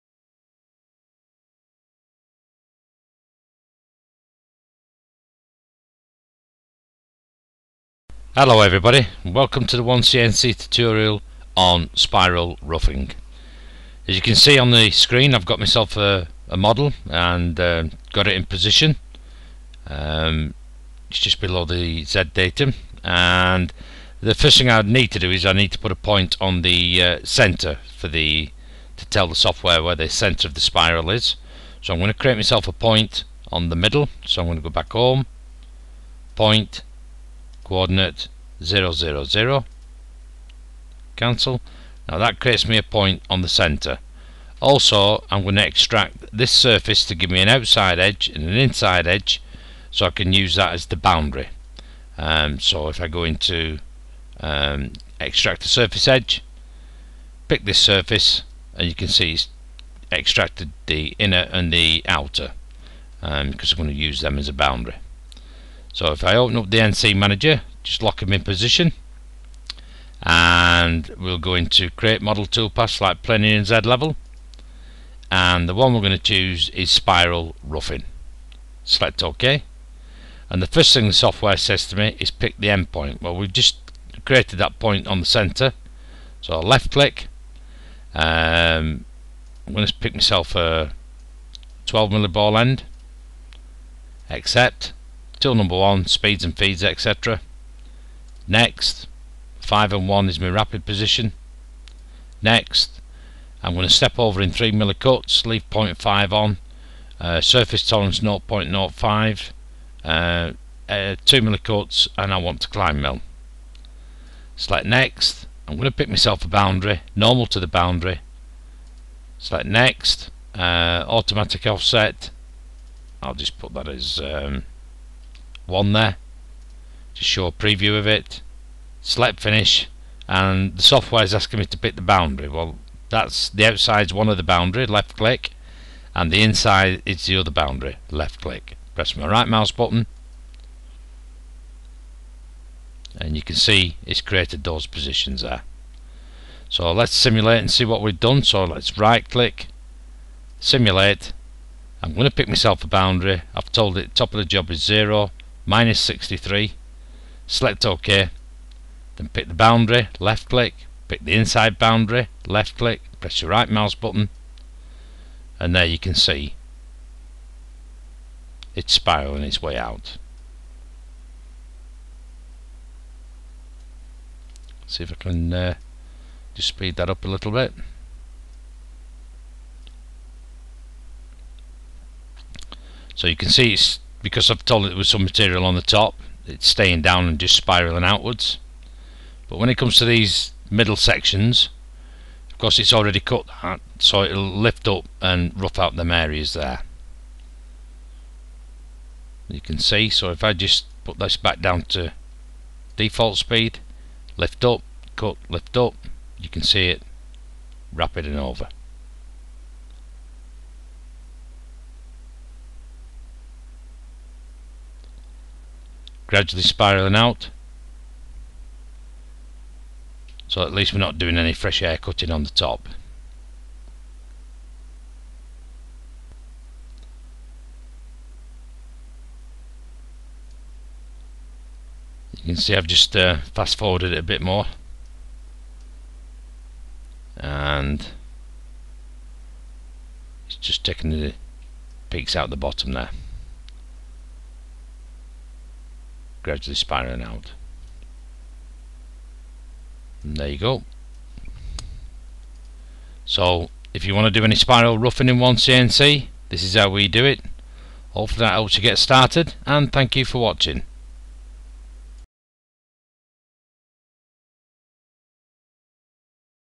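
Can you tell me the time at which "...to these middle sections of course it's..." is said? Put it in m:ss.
3:09.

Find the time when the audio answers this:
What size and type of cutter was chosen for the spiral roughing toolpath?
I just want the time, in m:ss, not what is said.
1:31.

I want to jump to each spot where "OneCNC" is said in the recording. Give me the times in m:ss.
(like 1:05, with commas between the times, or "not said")
0:09, 4:15.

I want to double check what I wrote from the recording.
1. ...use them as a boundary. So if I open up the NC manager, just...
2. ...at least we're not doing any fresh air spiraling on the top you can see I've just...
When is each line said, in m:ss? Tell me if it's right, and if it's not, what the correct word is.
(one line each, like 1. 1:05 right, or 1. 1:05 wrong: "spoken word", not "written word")
1. 1:03 right
2. 3:40 wrong: "cutting", not "spiraling".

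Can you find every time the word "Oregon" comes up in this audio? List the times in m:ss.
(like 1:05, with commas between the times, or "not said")
not said.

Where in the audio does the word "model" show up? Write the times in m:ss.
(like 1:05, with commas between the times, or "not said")
0:16, 1:12.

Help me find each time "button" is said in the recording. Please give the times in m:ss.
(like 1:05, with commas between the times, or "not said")
2:19, 2:43.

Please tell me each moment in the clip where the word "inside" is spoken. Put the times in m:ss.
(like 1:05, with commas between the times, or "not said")
0:48, 2:16, 2:41.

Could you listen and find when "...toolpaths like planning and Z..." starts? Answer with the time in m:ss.
1:12.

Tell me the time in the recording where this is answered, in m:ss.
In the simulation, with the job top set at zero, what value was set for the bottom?
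2:35.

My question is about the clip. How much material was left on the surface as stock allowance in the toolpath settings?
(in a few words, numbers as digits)
0.5.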